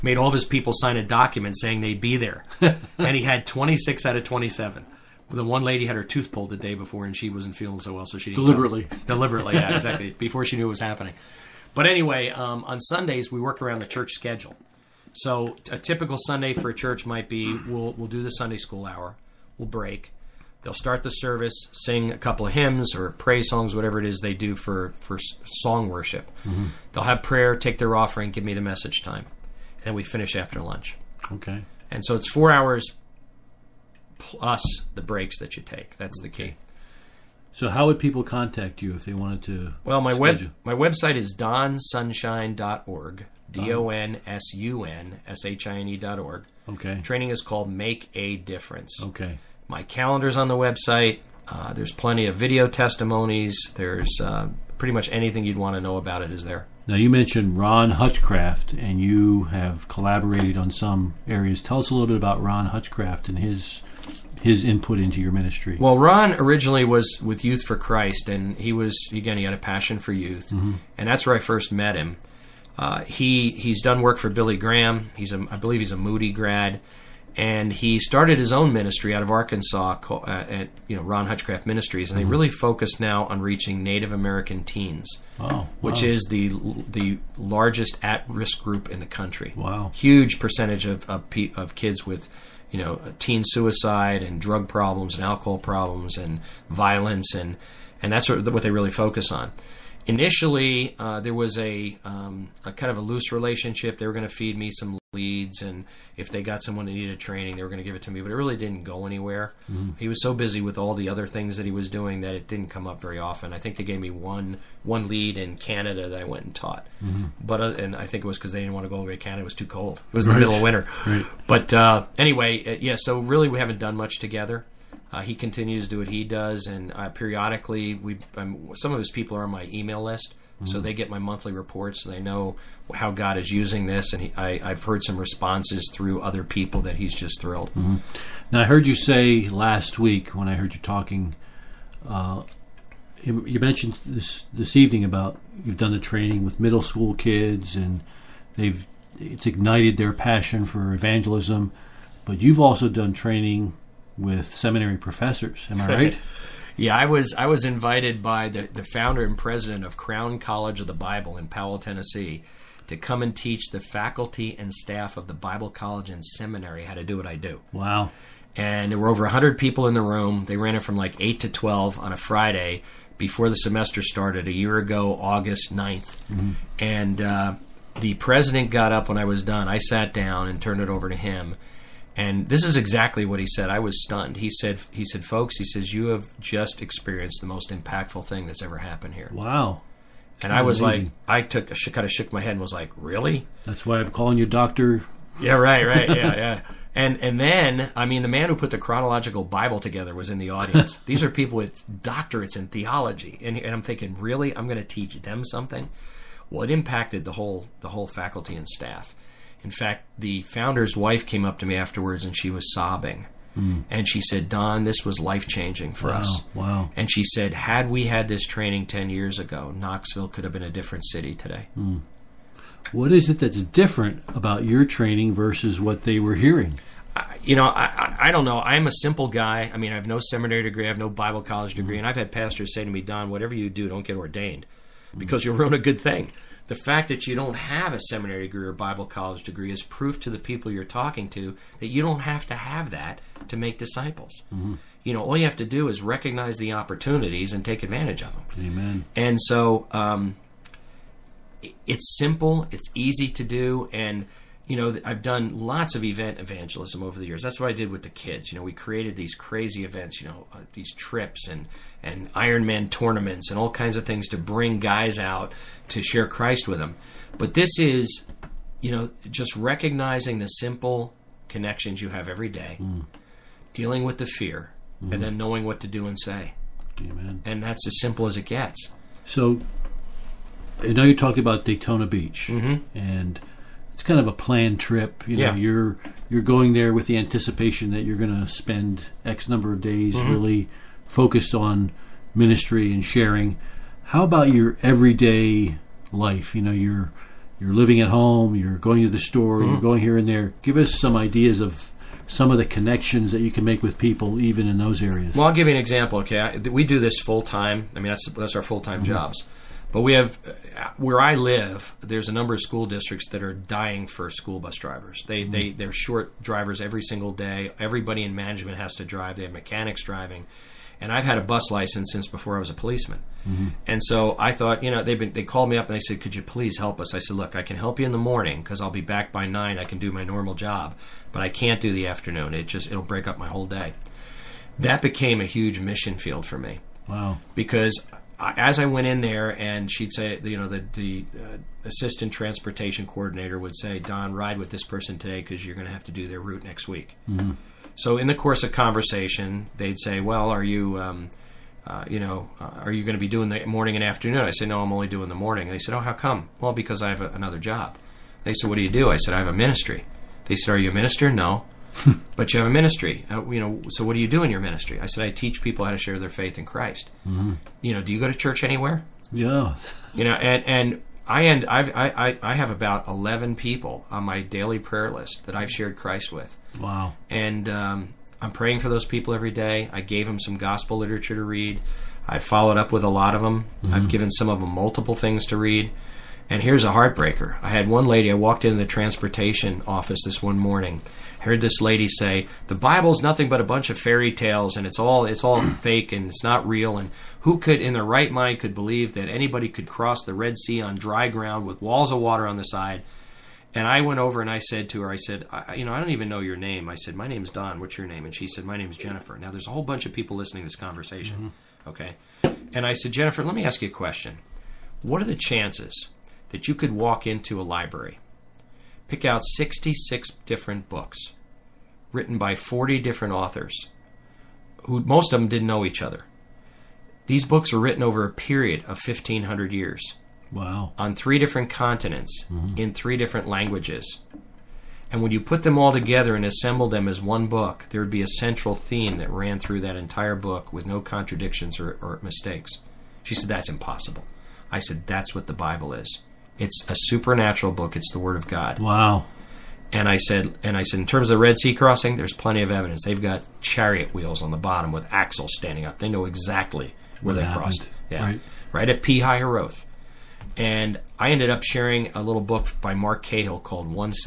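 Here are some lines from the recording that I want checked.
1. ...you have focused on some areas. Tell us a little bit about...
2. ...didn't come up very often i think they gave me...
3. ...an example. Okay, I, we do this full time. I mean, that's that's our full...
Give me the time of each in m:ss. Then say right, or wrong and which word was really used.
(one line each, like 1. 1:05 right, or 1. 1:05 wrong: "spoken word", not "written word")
1. 0:58 wrong: "collaborated", not "focused"
2. 1:52 right
3. 5:05 right.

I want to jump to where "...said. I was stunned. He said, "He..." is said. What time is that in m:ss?
3:03.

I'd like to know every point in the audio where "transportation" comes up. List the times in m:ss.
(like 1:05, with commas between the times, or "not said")
5:42, 6:28.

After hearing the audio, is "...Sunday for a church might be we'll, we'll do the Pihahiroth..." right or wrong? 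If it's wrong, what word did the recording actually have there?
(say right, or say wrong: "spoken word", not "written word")
wrong: "Sunday", not "Pihahiroth".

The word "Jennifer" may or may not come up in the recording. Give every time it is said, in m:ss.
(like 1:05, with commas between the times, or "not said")
6:48, 6:53.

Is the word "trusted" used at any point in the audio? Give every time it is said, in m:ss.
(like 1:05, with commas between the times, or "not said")
not said.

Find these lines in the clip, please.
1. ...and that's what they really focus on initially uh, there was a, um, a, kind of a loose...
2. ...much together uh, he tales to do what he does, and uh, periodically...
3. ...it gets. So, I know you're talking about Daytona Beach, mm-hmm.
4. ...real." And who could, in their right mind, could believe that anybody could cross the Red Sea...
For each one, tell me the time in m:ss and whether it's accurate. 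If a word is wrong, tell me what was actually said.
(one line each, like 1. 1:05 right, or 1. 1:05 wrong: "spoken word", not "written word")
1. 1:38 right
2. 2:03 wrong: "continues", not "tales"
3. 4:38 right
4. 6:36 right.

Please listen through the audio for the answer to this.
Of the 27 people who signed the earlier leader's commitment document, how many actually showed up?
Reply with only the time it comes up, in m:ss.
0:03.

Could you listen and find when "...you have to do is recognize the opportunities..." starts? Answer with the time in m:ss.
4:05.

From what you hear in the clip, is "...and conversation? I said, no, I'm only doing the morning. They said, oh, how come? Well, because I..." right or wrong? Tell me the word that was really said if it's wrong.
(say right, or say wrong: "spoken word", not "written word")
wrong: "afternoon", not "conversation".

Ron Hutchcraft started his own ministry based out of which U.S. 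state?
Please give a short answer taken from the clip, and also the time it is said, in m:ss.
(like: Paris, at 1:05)
Arkansas, at 1:19.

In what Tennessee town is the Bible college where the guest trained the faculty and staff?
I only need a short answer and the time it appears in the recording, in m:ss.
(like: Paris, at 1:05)
Powell, at 2:41.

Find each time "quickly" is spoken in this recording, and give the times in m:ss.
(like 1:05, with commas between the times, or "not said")
not said.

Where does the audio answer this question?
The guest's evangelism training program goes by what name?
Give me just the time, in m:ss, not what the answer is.
0:47.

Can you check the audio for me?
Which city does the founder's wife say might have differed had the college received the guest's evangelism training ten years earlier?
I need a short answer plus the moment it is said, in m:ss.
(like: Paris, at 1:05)
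Knoxville, at 3:39.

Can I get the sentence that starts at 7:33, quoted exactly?
They've got chariot wheels on the bottom with axles standing up.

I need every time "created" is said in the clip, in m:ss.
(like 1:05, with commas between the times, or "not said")
4:18.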